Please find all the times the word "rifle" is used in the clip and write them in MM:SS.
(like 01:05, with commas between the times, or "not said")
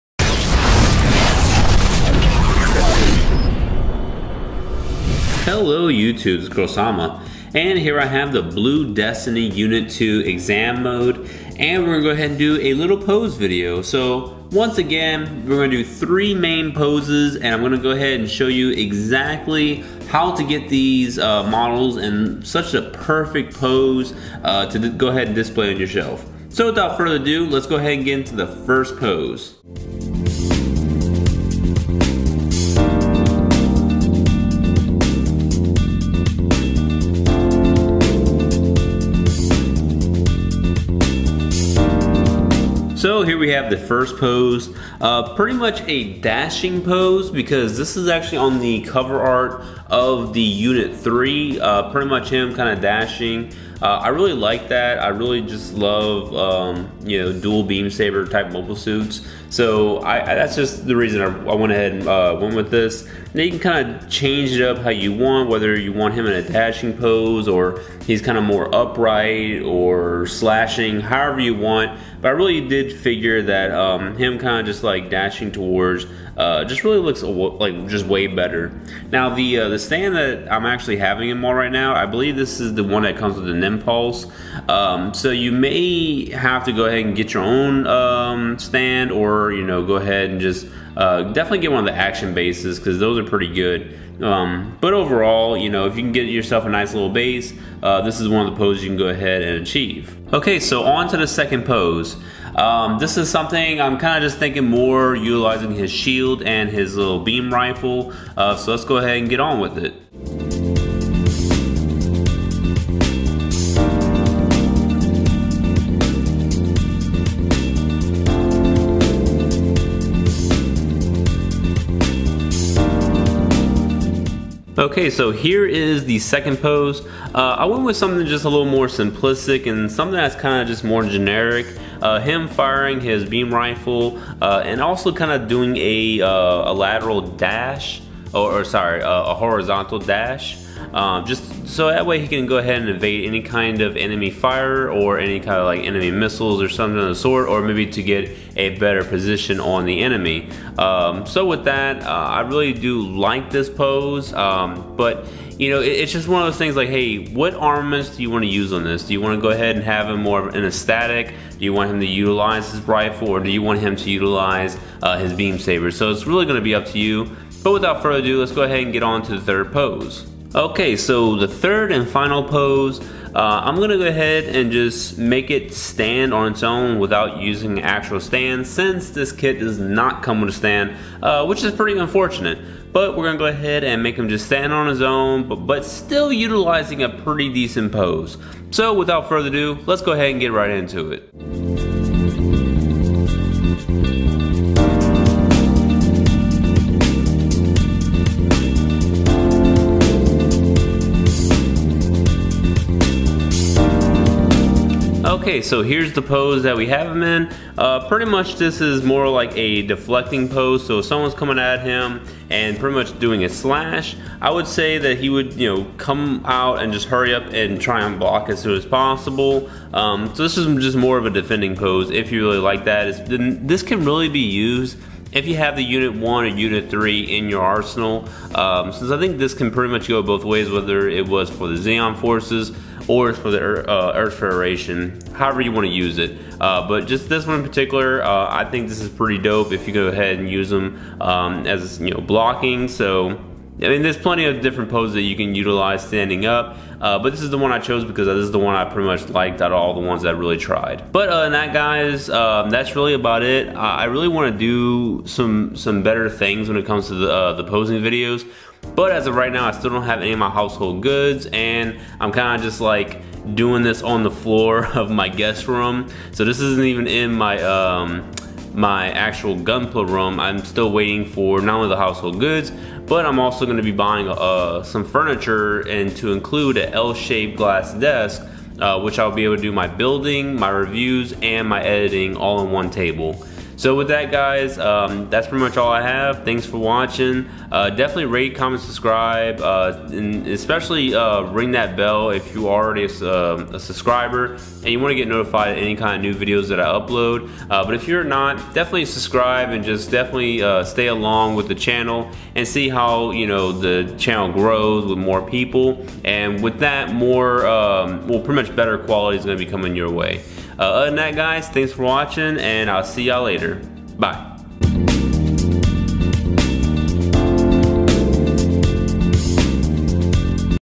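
01:47, 02:13, 02:42.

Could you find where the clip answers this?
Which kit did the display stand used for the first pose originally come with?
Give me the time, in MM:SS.
01:23.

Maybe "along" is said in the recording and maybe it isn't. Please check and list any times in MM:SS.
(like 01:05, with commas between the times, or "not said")
05:01.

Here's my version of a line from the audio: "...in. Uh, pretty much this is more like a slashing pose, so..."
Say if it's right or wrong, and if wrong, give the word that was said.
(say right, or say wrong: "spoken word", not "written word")
wrong: "deflecting", not "slashing".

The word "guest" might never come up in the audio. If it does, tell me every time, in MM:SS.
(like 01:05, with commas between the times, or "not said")
04:25.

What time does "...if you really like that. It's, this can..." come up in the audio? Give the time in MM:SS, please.
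03:42.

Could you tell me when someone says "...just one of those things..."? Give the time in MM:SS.
02:36.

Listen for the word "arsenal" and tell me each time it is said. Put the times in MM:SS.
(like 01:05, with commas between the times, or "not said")
03:47.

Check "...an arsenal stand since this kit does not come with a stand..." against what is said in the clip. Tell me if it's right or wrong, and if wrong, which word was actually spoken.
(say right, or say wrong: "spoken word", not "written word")
wrong: "actual", not "arsenal".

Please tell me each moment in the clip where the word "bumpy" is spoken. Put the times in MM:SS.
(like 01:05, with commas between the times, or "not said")
not said.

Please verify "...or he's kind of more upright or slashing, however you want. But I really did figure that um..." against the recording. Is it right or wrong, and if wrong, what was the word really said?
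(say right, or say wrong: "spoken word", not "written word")
right.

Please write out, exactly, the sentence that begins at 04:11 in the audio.
But uh, and that, guys, um, that's really about it.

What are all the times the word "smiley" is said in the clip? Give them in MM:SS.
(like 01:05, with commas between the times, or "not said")
not said.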